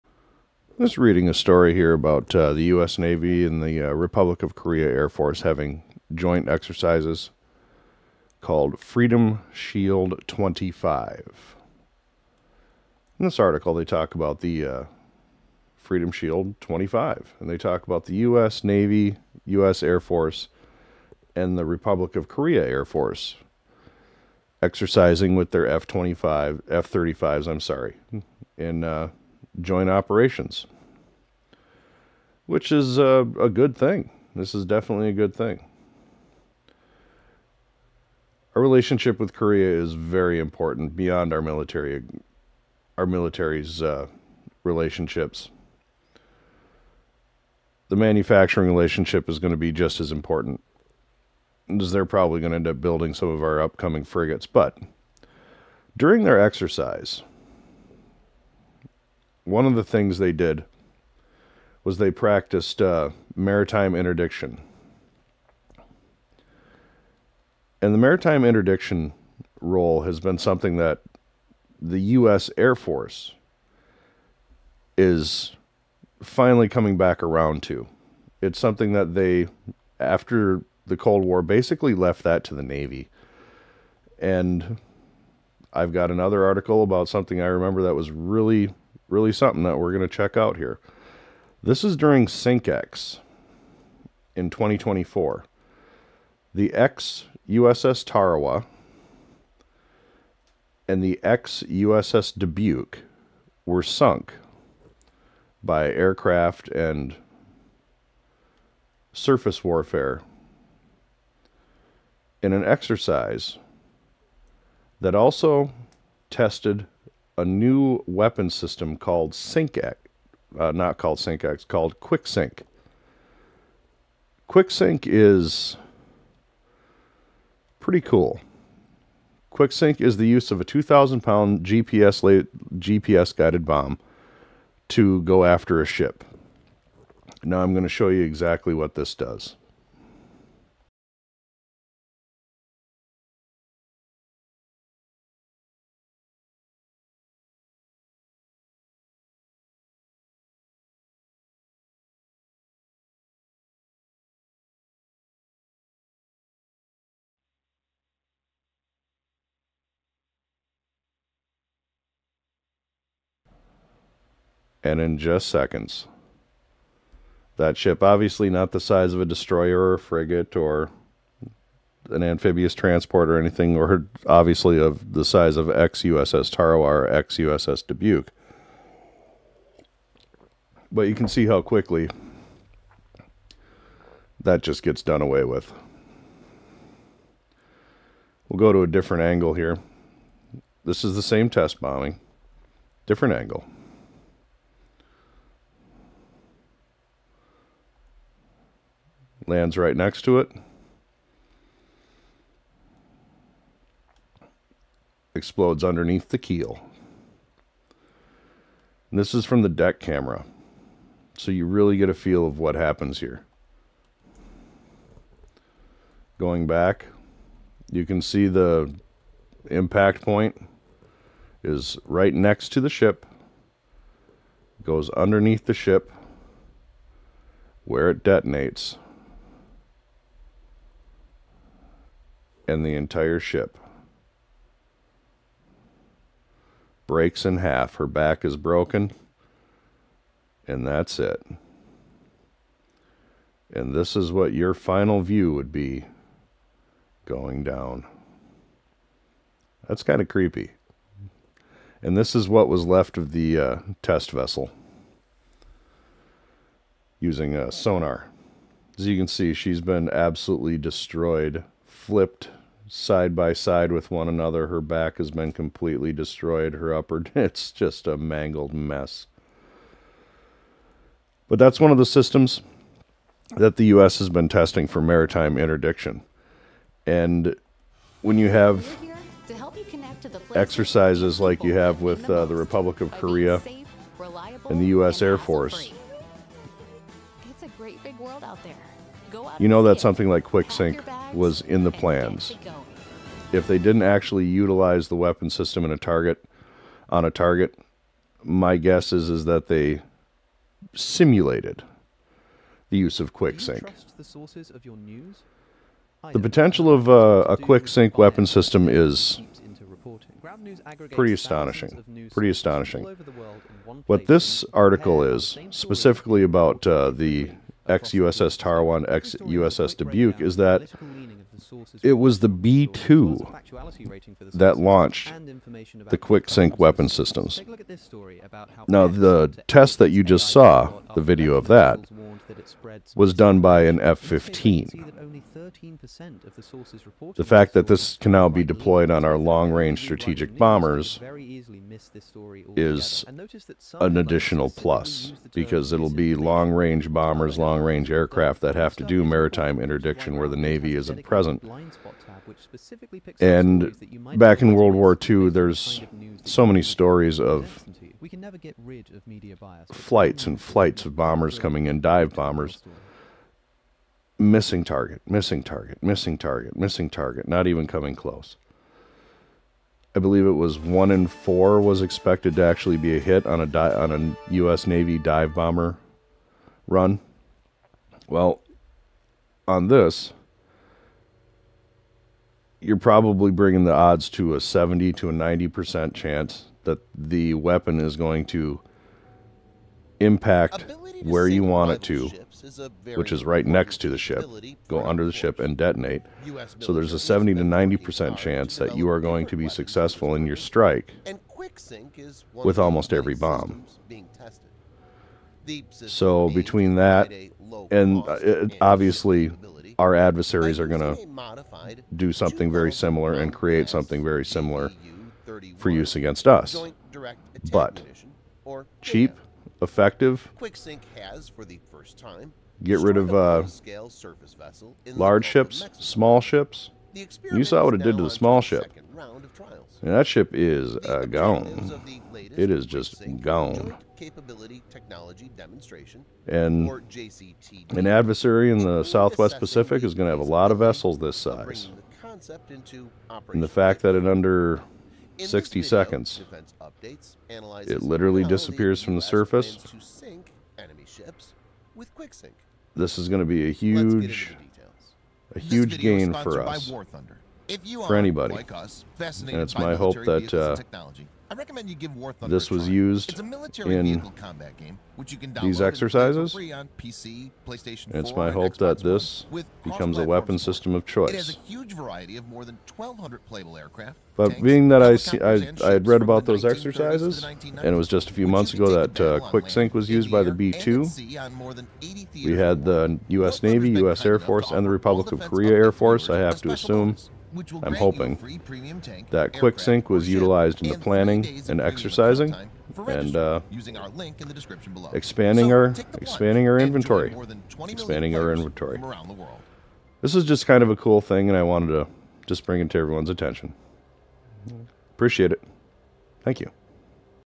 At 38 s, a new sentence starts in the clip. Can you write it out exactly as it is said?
Our relationship with Korea is very important beyond our military, our military's uh, relationships.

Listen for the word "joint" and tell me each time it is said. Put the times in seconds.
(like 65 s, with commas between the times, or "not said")
6 s, 29 s.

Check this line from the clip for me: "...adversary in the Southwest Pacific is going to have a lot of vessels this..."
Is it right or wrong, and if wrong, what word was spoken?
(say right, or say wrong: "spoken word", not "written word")
right.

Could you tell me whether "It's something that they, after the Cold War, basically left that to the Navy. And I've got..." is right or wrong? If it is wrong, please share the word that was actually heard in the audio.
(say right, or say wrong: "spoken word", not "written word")
right.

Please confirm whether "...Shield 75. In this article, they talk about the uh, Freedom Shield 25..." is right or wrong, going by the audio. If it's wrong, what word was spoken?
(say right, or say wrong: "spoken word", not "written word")
wrong: "25", not "75".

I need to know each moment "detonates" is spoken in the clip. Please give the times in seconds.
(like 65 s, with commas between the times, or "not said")
228 s, 395 s.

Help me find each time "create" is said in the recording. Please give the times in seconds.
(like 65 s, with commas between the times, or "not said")
413 s.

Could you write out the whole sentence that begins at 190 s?
This is the same test bombing, different angle.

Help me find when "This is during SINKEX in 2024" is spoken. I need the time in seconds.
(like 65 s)
91 s.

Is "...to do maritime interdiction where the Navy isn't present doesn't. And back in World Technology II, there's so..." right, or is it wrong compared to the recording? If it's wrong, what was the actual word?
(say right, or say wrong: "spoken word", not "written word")
wrong: "War", not "Technology".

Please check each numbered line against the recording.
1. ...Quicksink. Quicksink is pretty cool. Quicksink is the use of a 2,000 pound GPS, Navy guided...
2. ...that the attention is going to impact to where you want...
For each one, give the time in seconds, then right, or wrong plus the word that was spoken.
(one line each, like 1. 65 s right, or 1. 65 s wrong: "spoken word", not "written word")
1. 121 s wrong: "GPS", not "Navy"
2. 386 s wrong: "weapon", not "attention".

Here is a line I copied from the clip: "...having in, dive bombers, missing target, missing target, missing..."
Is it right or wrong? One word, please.
wrong.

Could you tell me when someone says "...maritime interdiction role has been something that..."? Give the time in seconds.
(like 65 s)
67 s.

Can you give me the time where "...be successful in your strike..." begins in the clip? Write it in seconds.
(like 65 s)
399 s.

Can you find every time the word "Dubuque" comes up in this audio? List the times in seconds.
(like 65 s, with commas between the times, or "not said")
102 s, 177 s, 319 s.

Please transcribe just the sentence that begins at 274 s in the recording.
has been testing for maritime interdiction.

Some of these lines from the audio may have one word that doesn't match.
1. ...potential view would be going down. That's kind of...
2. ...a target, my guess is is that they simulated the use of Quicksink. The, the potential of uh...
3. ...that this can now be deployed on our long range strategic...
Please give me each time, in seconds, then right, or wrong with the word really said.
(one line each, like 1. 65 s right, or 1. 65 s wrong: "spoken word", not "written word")
1. 244 s wrong: "final", not "potential"
2. 297 s right
3. 337 s right.